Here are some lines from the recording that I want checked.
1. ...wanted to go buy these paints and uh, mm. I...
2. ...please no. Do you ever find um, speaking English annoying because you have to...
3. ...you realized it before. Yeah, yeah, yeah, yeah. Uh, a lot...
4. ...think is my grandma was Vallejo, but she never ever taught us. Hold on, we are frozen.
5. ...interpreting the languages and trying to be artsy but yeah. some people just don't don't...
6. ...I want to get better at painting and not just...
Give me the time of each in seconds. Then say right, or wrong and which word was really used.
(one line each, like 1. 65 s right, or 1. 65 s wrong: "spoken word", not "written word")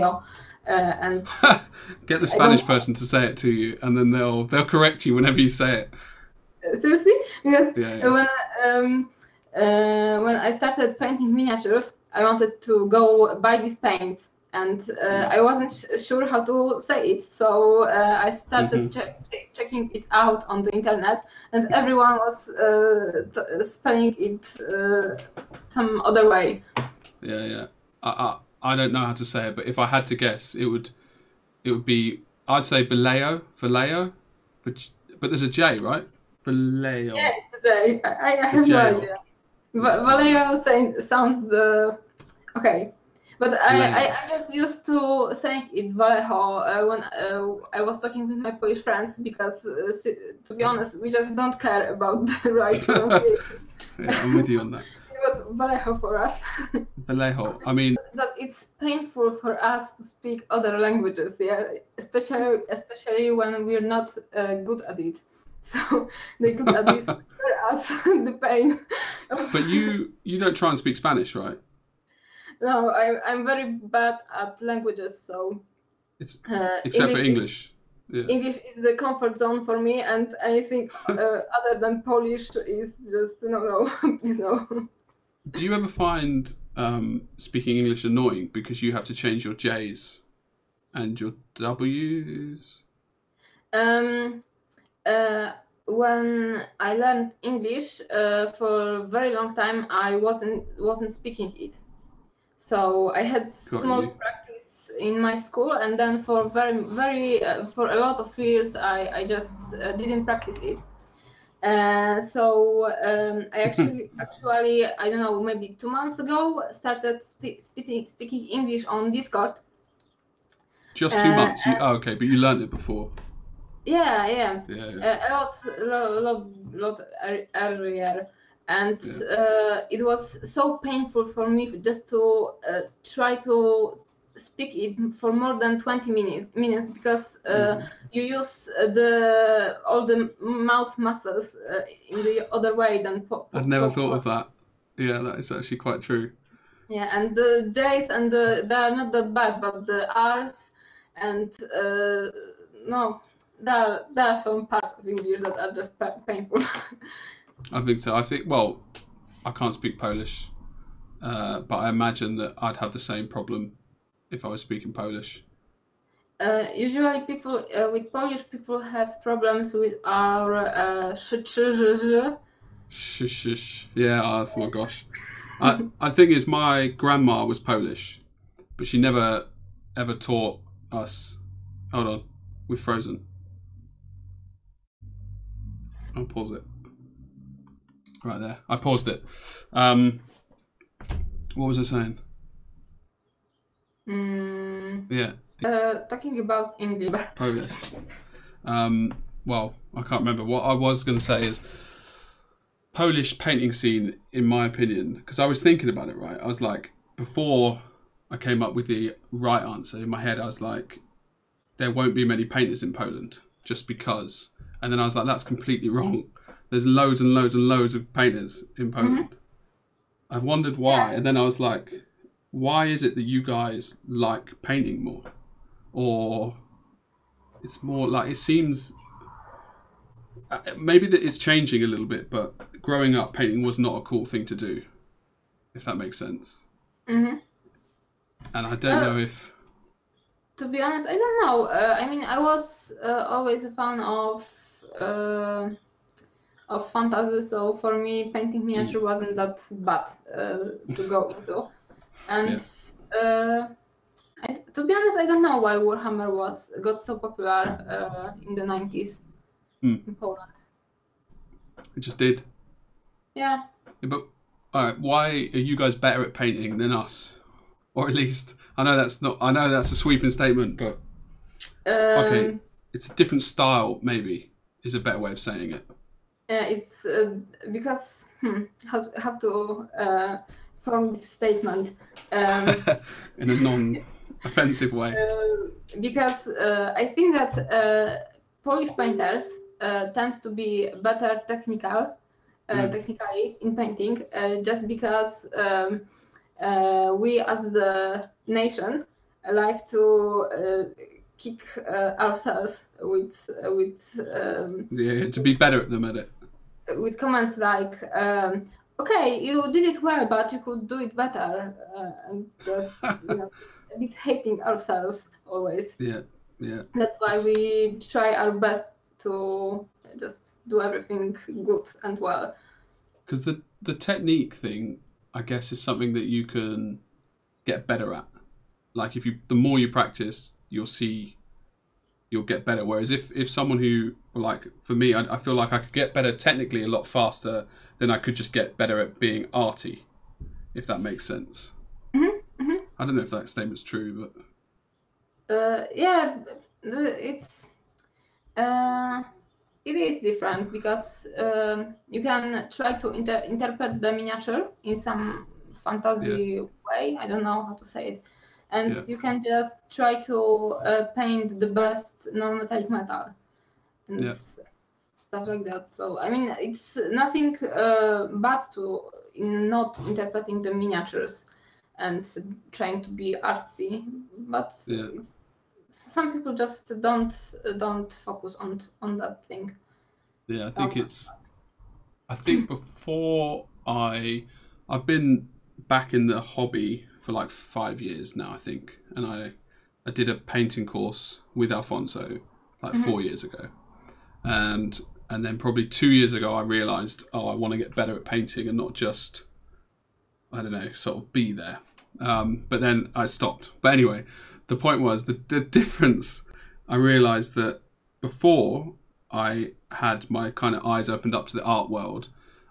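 1. 12 s right
2. 84 s right
3. 122 s wrong: "learned", not "realized"
4. 176 s wrong: "Polish", not "Vallejo"
5. 370 s wrong: "miniatures", not "languages"
6. 397 s right.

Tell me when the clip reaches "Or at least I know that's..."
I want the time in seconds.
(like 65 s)
267 s.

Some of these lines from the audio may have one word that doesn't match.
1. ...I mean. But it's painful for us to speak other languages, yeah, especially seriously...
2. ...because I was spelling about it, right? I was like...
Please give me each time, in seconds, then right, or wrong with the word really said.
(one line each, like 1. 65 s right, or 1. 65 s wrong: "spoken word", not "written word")
1. 57 s wrong: "especially", not "seriously"
2. 205 s wrong: "thinking", not "spelling".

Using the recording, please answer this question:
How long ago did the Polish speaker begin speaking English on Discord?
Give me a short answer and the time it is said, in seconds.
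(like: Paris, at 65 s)
two months ago, at 115 s.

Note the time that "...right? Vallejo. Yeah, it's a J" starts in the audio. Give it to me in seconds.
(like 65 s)
35 s.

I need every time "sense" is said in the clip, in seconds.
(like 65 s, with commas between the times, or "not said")
236 s, 341 s.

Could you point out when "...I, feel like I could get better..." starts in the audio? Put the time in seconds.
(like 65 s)
335 s.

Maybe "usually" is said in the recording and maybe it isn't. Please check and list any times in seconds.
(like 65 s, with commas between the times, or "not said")
166 s.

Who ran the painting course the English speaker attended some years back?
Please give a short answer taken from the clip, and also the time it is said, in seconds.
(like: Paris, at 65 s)
Alfonso, at 391 s.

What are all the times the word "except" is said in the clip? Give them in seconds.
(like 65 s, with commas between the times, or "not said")
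76 s.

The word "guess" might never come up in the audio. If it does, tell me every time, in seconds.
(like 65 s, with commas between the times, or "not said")
30 s, 325 s.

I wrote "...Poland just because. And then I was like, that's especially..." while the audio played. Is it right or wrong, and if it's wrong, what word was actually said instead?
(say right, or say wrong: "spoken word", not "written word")
wrong: "completely", not "especially".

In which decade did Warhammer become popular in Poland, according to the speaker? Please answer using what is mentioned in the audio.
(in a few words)
the 90s.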